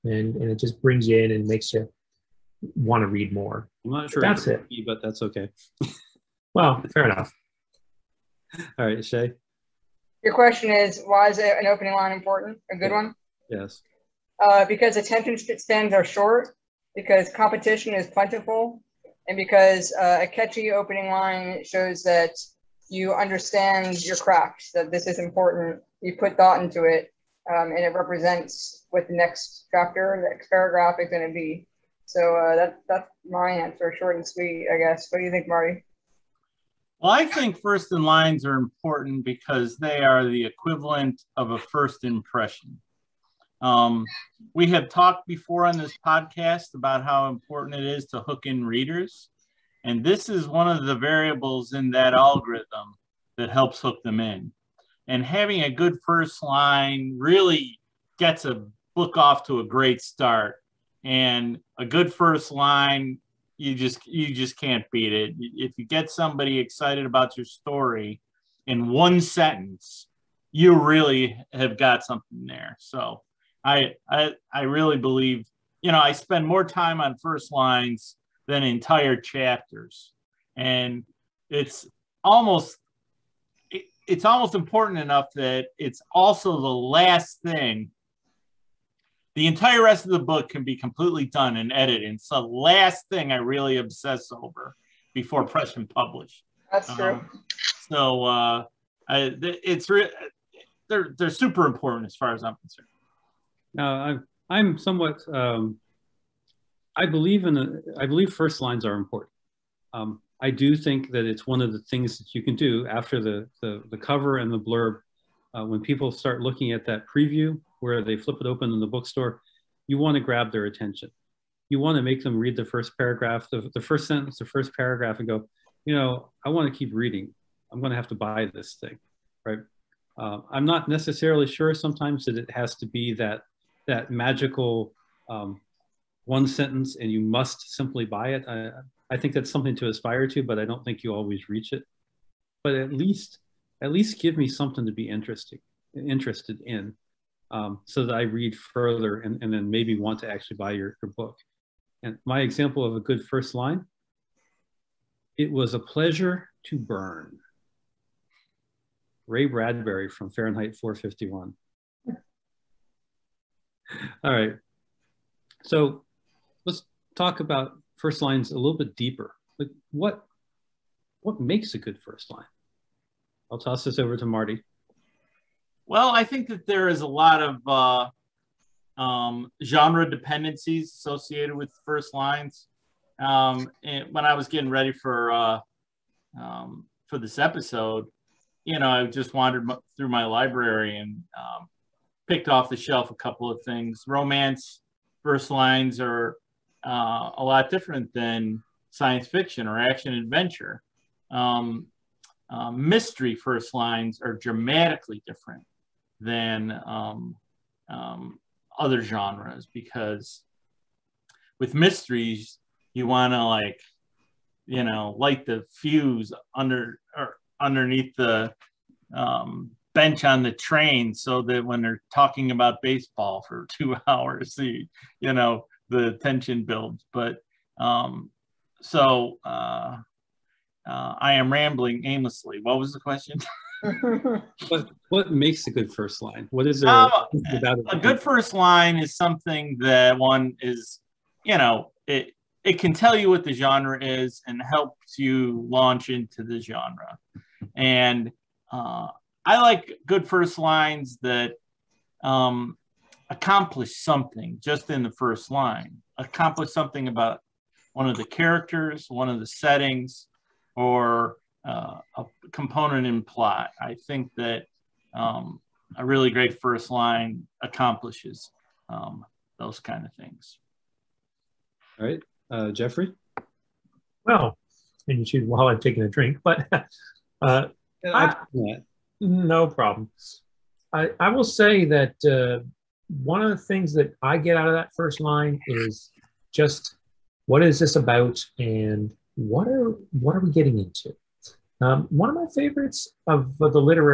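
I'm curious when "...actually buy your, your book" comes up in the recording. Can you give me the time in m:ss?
2:30.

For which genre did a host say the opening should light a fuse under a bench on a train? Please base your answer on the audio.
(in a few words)
Mysteries.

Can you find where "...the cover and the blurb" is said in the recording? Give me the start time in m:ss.
1:53.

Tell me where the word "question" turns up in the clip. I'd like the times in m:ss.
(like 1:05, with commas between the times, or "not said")
0:10, 3:52.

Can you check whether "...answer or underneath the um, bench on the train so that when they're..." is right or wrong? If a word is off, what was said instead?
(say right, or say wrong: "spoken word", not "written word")
wrong: "under", not "answer".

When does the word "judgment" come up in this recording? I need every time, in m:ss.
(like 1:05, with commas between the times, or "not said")
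not said.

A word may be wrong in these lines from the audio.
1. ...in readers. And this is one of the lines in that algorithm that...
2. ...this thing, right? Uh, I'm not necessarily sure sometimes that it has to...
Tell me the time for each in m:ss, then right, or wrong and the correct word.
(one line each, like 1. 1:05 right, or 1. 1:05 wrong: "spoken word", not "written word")
1. 0:48 wrong: "variables", not "lines"
2. 2:08 right.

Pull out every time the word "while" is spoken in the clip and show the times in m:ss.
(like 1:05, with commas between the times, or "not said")
4:35.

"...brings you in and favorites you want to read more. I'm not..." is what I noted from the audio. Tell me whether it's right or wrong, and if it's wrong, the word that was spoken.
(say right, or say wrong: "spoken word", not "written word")
wrong: "makes", not "favorites".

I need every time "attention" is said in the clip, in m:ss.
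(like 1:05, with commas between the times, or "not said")
0:14, 2:00.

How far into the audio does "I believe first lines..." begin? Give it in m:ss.
1:47.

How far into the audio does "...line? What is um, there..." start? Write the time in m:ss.
3:56.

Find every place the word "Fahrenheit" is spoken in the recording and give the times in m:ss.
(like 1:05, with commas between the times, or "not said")
2:40.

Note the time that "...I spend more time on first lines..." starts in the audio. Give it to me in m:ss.
1:15.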